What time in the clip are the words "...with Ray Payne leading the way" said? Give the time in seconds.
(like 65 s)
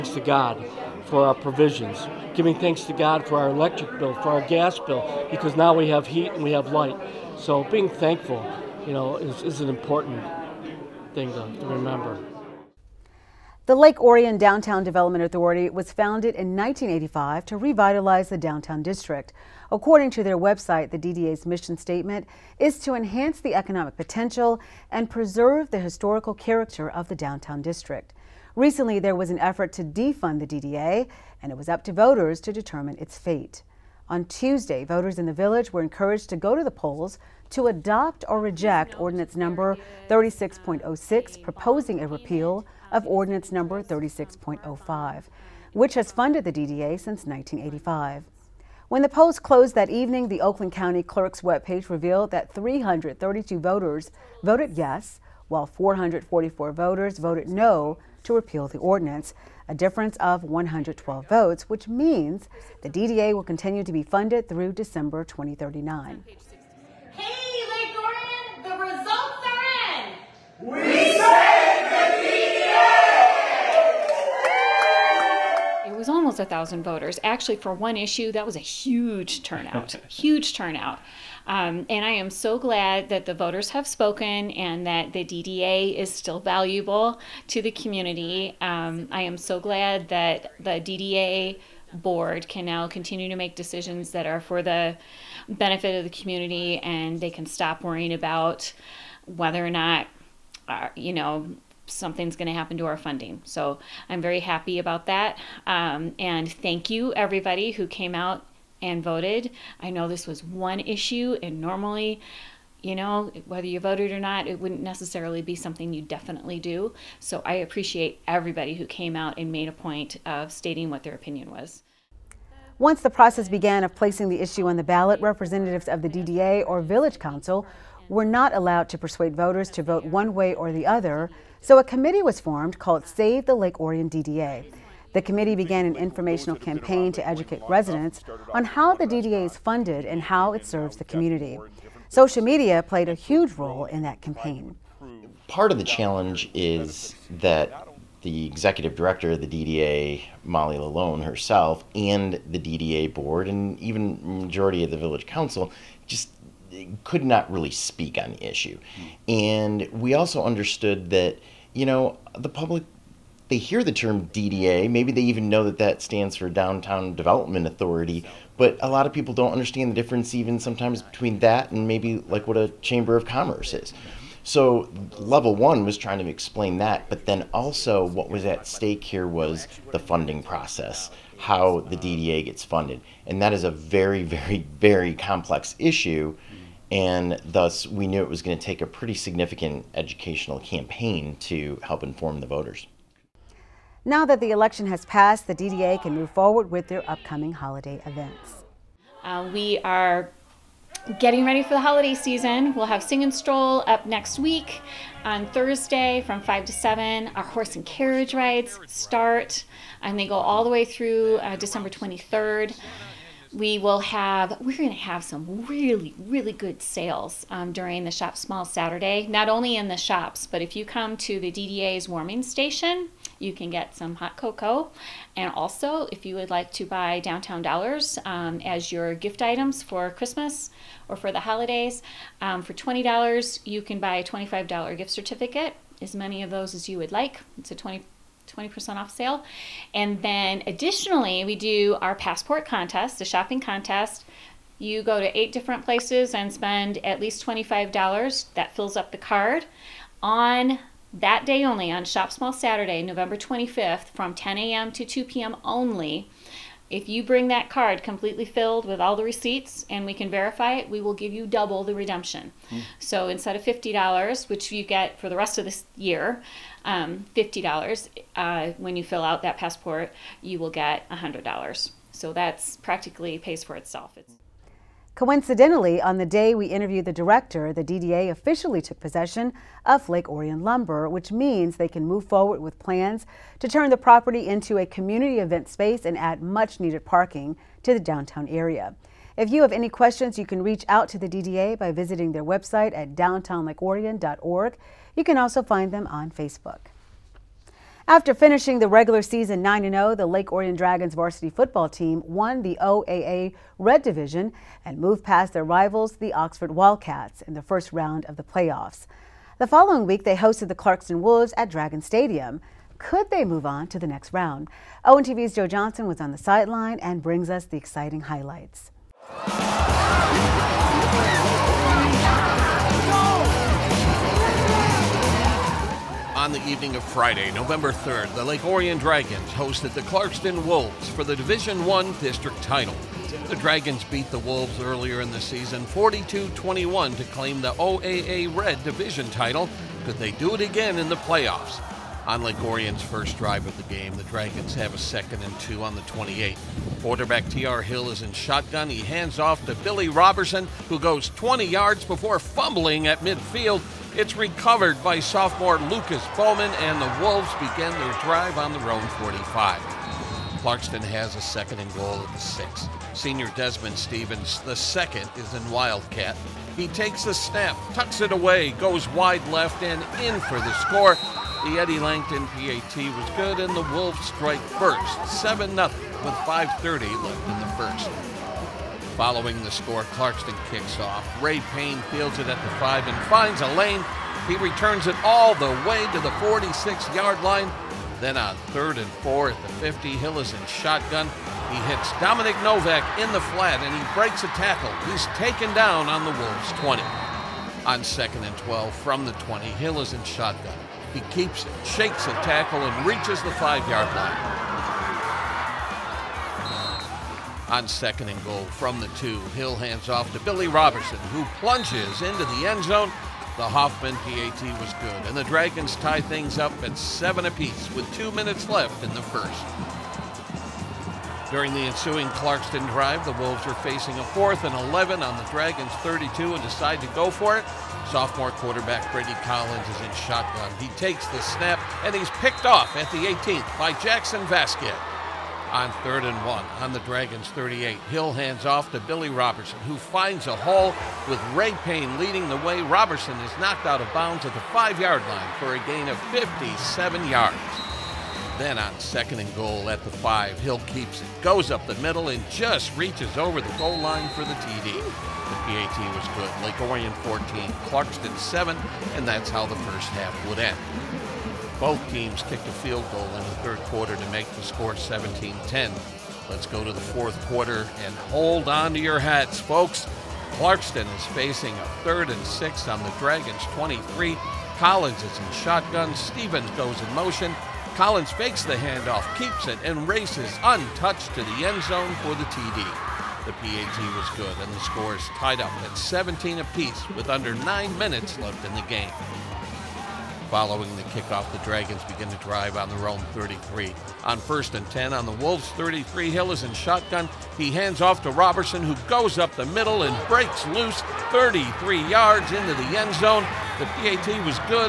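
441 s.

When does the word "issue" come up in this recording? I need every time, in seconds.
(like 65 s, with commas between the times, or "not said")
77 s, 110 s, 124 s, 158 s, 185 s.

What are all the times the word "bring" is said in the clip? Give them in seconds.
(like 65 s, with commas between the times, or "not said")
257 s, 317 s.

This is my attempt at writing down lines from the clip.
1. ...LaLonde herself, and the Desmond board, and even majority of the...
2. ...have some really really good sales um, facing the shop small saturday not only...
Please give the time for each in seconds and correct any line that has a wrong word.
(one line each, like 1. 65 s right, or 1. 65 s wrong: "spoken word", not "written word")
1. 150 s wrong: "DDA", not "Desmond"
2. 214 s wrong: "during", not "facing".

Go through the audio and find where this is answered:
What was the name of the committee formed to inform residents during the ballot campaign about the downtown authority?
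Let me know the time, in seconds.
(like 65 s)
133 s.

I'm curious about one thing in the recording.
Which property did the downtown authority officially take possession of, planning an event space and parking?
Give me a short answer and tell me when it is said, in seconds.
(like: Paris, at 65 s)
Lake Orion Lumber, at 280 s.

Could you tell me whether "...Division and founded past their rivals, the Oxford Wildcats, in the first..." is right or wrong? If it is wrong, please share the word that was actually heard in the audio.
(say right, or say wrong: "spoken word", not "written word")
wrong: "moved", not "founded".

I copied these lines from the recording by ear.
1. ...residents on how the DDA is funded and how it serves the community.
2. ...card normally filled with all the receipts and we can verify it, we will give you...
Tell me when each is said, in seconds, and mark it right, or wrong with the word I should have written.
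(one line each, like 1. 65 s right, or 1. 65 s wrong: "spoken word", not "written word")
1. 137 s right
2. 257 s wrong: "completely", not "normally".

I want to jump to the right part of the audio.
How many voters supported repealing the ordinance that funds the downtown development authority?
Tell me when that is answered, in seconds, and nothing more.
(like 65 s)
52 s.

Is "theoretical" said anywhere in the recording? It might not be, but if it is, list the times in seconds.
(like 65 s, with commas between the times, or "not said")
not said.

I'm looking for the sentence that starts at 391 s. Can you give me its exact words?
He hits Dominic Novak in the flat and he breaks a tackle.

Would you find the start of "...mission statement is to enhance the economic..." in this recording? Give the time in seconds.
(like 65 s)
21 s.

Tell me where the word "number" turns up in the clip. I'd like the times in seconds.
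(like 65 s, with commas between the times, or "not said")
39 s, 43 s.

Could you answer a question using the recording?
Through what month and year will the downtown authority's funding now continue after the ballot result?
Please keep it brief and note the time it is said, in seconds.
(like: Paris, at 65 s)
December 2039, at 64 s.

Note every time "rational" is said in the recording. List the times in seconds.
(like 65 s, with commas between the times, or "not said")
not said.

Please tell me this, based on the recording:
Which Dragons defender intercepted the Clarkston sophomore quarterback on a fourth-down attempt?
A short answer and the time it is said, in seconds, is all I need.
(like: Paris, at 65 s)
Jackson Vasquez, at 434 s.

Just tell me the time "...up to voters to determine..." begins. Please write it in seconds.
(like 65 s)
31 s.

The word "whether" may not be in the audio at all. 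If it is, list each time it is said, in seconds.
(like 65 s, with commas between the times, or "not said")
99 s, 113 s.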